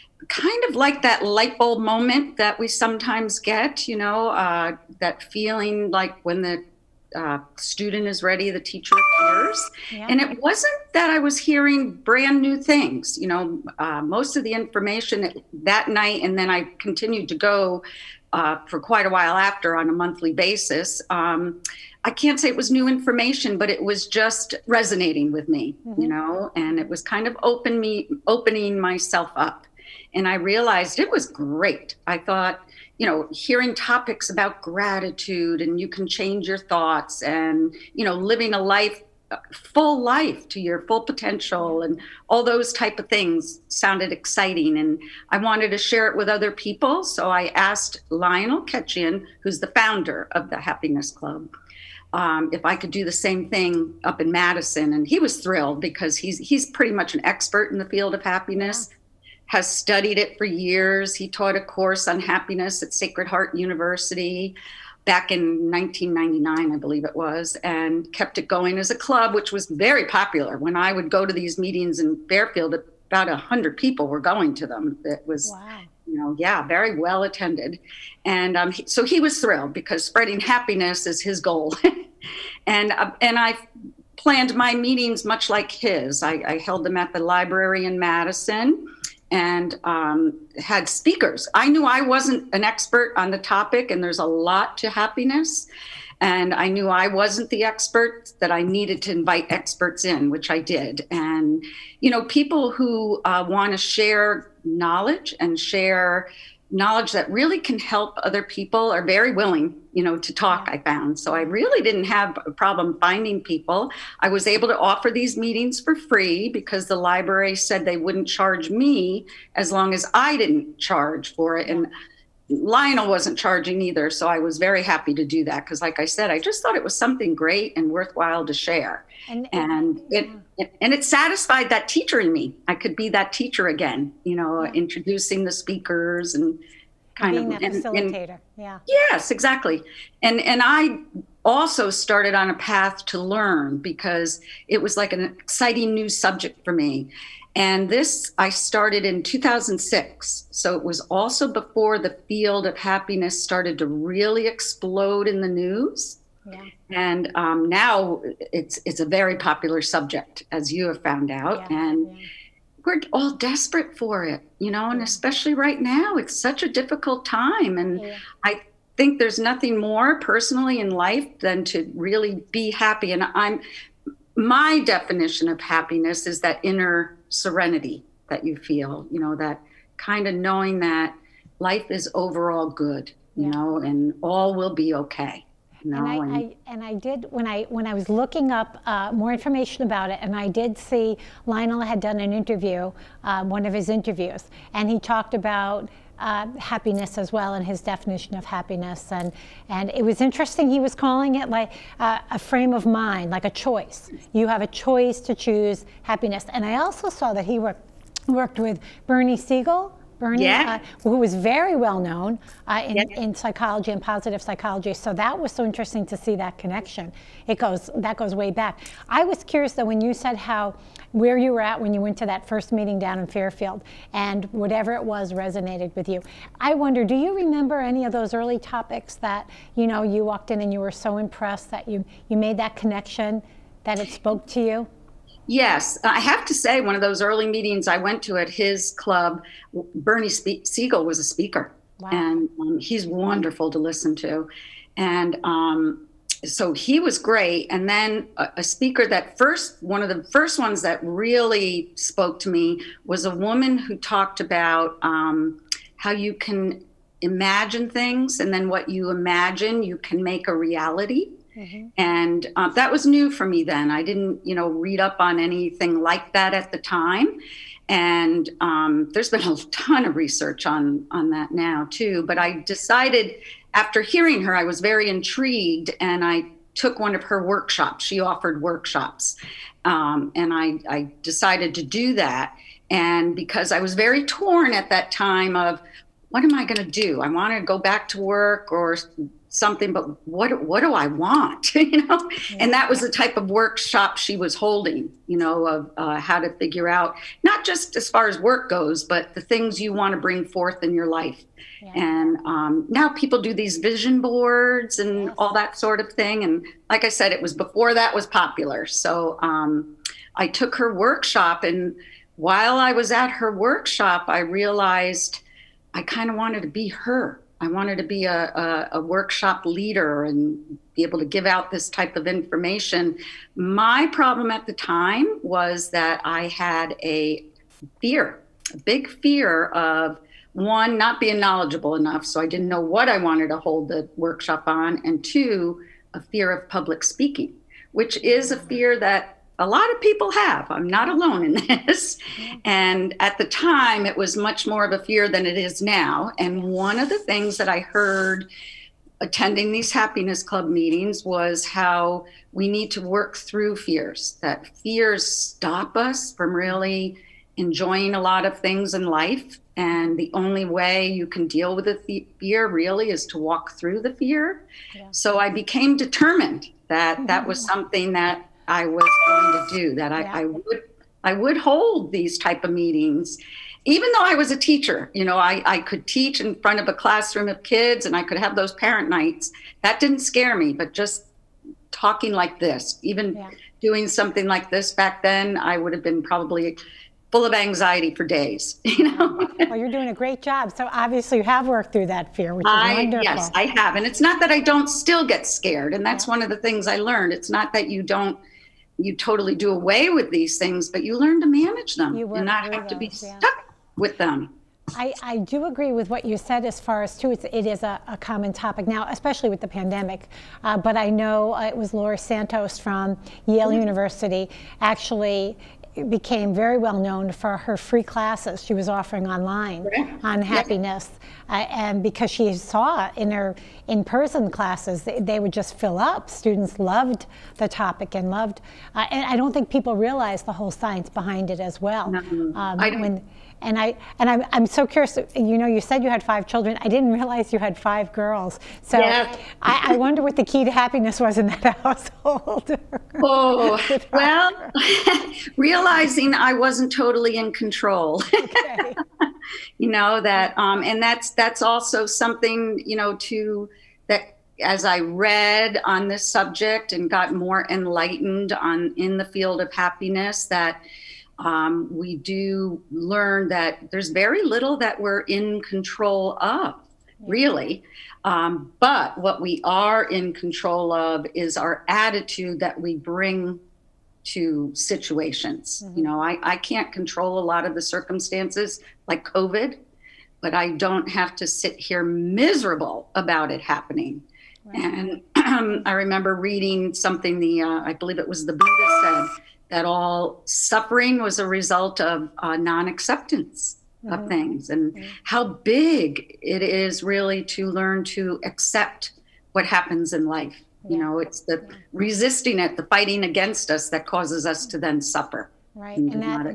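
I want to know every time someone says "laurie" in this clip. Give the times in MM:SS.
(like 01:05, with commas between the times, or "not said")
06:51.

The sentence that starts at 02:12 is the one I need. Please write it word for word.
I could be that teacher again, you know, introducing the speakers and kind being of that and, facilitator.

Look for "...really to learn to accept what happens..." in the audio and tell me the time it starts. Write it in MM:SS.
08:17.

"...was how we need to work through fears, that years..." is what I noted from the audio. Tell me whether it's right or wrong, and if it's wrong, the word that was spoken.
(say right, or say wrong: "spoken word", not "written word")
wrong: "fears", not "years".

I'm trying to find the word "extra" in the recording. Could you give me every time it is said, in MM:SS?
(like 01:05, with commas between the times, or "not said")
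not said.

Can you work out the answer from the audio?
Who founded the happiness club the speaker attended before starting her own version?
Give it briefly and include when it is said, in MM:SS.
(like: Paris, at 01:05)
Lionel Ketchian, at 00:48.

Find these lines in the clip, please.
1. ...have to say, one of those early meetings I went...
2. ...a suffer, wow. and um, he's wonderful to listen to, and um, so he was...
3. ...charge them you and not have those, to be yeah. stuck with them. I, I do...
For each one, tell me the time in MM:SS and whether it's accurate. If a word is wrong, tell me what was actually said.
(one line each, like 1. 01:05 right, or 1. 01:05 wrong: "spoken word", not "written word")
1. 03:56 right
2. 04:01 wrong: "speaker", not "suffer"
3. 06:41 wrong: "manage", not "charge".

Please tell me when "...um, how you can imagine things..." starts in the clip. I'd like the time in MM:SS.
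04:15.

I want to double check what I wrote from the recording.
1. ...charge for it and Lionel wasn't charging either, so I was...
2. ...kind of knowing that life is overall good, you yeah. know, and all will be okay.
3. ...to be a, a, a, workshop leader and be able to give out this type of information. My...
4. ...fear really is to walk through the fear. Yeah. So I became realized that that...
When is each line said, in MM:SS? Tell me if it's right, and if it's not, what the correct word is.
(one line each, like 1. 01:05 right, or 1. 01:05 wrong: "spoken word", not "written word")
1. 02:00 right
2. 02:59 right
3. 05:17 right
4. 06:02 wrong: "determined", not "realized".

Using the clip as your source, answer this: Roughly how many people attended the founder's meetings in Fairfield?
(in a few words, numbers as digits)
100.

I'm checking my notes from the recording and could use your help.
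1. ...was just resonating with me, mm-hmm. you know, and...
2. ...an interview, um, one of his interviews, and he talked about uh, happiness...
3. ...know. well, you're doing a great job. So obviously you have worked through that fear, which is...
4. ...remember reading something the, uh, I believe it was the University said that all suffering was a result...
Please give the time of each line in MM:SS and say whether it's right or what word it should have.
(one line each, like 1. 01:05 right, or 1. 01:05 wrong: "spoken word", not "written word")
1. 00:23 right
2. 03:12 right
3. 06:29 right
4. 08:05 wrong: "Buddha", not "University".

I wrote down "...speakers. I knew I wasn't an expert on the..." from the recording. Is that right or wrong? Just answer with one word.
right.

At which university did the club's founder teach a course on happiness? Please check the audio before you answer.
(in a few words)
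Sacred Heart University.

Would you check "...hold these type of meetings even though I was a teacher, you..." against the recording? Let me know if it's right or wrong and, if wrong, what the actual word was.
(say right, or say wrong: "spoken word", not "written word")
right.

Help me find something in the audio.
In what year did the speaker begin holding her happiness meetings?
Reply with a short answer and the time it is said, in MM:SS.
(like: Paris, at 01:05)
2006, at 02:29.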